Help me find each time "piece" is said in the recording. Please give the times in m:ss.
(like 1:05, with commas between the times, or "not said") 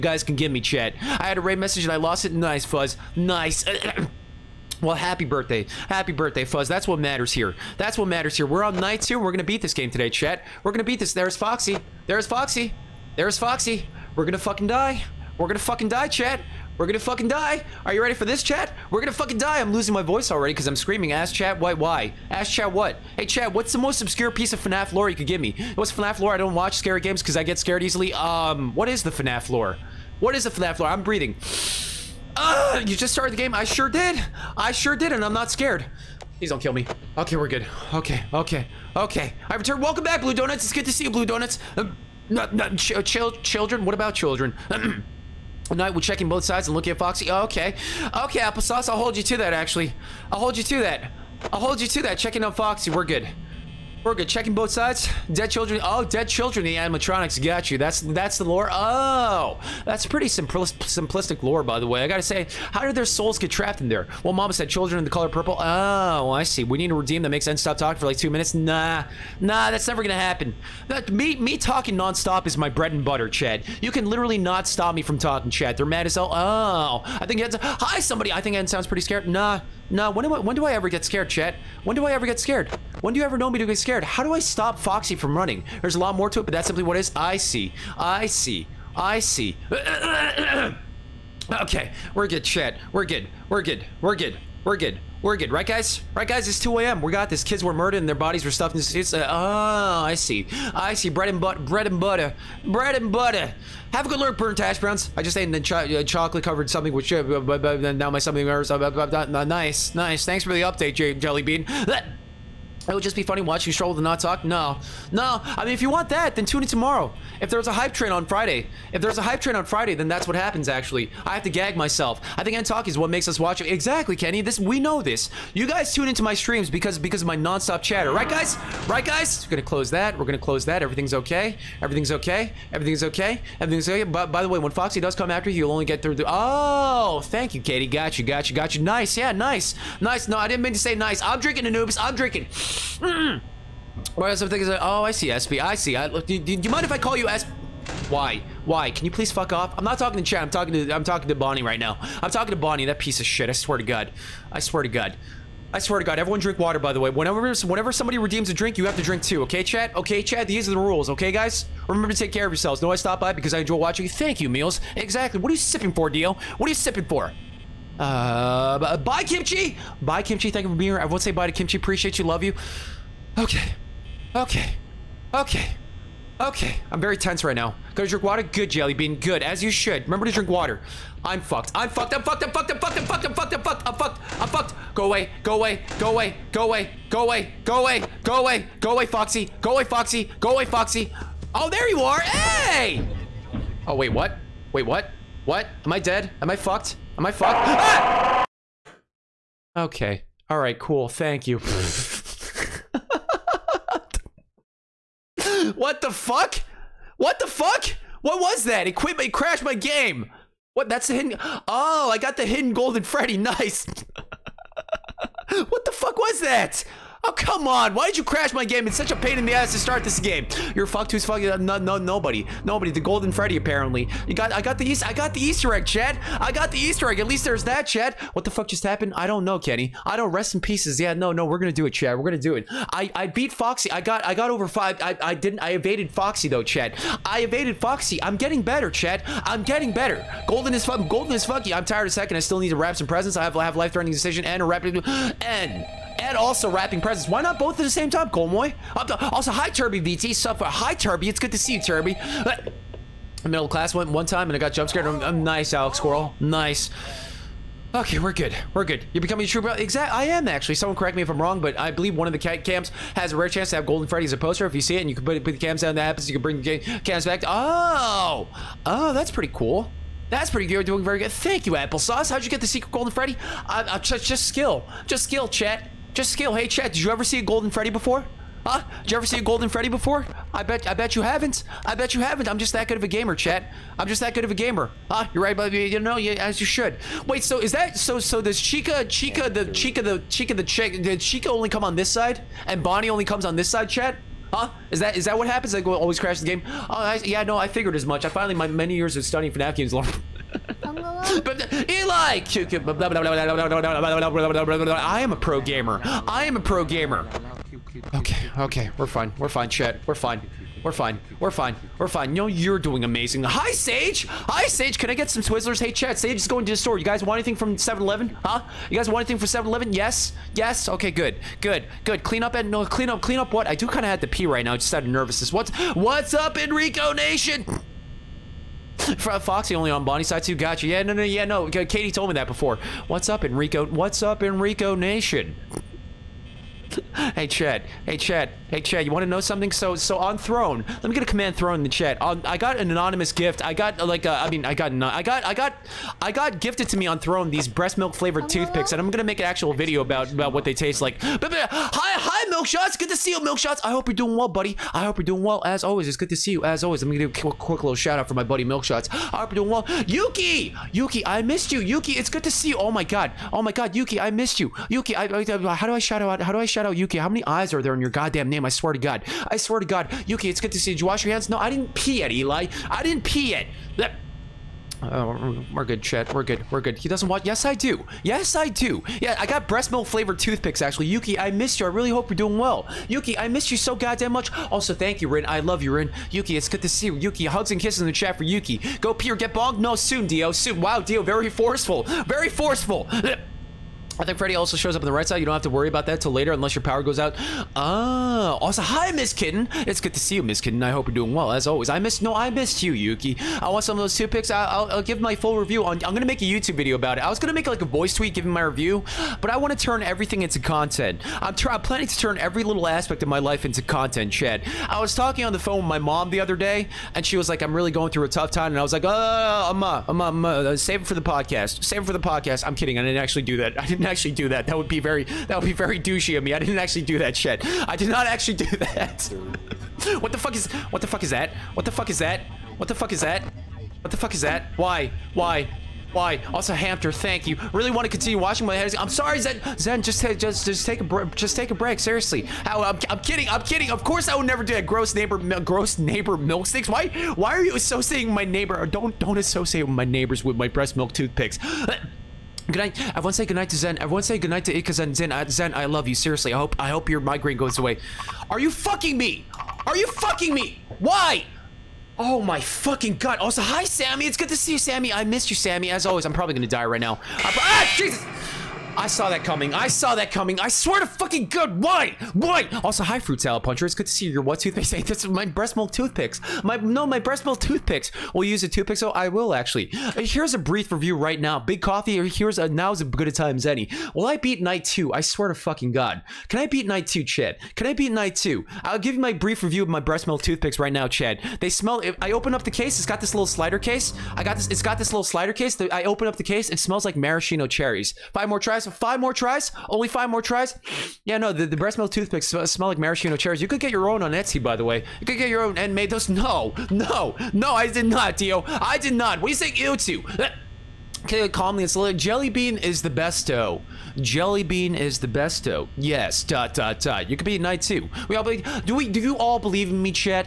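0:24, 2:32, 3:50.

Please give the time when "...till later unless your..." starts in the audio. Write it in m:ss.
6:36.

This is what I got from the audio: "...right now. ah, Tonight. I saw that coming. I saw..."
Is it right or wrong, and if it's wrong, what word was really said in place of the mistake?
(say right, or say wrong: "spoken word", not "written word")
wrong: "Jesus", not "Tonight".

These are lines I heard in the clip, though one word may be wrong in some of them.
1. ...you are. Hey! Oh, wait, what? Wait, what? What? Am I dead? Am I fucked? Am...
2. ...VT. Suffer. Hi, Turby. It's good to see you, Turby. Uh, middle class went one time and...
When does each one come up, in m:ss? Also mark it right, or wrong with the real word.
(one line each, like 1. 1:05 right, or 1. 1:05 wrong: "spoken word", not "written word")
1. 3:11 right
2. 4:10 right.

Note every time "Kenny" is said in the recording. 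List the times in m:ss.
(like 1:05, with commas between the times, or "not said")
2:04, 3:49.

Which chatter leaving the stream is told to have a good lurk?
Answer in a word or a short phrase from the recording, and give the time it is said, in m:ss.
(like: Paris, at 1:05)
burnt hash browns, at 1:44.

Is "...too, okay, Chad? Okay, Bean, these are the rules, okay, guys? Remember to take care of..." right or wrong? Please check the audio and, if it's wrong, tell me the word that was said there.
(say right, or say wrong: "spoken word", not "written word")
wrong: "Chad", not "Bean".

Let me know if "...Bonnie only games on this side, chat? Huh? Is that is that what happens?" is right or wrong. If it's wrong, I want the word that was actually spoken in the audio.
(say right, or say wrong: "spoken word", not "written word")
wrong: "comes", not "games".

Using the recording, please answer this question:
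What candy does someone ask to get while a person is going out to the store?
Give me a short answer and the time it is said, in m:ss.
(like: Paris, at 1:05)
Twizzlers, at 5:15.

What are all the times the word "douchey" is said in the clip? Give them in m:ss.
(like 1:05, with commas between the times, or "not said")
7:05.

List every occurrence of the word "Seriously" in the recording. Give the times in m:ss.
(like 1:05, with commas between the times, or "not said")
7:21, 7:36.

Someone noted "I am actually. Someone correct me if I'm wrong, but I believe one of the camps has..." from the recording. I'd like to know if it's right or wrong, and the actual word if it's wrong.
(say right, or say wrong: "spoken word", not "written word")
right.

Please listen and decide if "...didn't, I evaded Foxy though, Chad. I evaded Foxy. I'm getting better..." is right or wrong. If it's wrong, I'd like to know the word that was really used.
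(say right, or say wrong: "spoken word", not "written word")
right.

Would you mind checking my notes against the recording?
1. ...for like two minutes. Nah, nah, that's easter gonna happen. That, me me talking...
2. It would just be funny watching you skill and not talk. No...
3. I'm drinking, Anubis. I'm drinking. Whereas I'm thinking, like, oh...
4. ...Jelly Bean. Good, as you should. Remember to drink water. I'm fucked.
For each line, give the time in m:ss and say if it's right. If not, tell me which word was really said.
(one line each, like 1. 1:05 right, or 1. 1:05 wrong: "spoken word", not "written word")
1. 1:07 wrong: "never", not "easter"
2. 1:52 wrong: "stroll", not "skill"
3. 2:21 right
4. 2:58 right.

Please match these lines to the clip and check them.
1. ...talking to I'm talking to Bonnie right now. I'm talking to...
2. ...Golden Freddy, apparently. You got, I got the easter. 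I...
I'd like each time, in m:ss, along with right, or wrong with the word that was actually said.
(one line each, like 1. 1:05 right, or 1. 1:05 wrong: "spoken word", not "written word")
1. 2:30 right
2. 3:43 right.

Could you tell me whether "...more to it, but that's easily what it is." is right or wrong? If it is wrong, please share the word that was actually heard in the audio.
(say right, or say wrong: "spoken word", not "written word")
wrong: "simply", not "easily".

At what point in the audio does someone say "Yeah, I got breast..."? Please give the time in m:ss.
6:19.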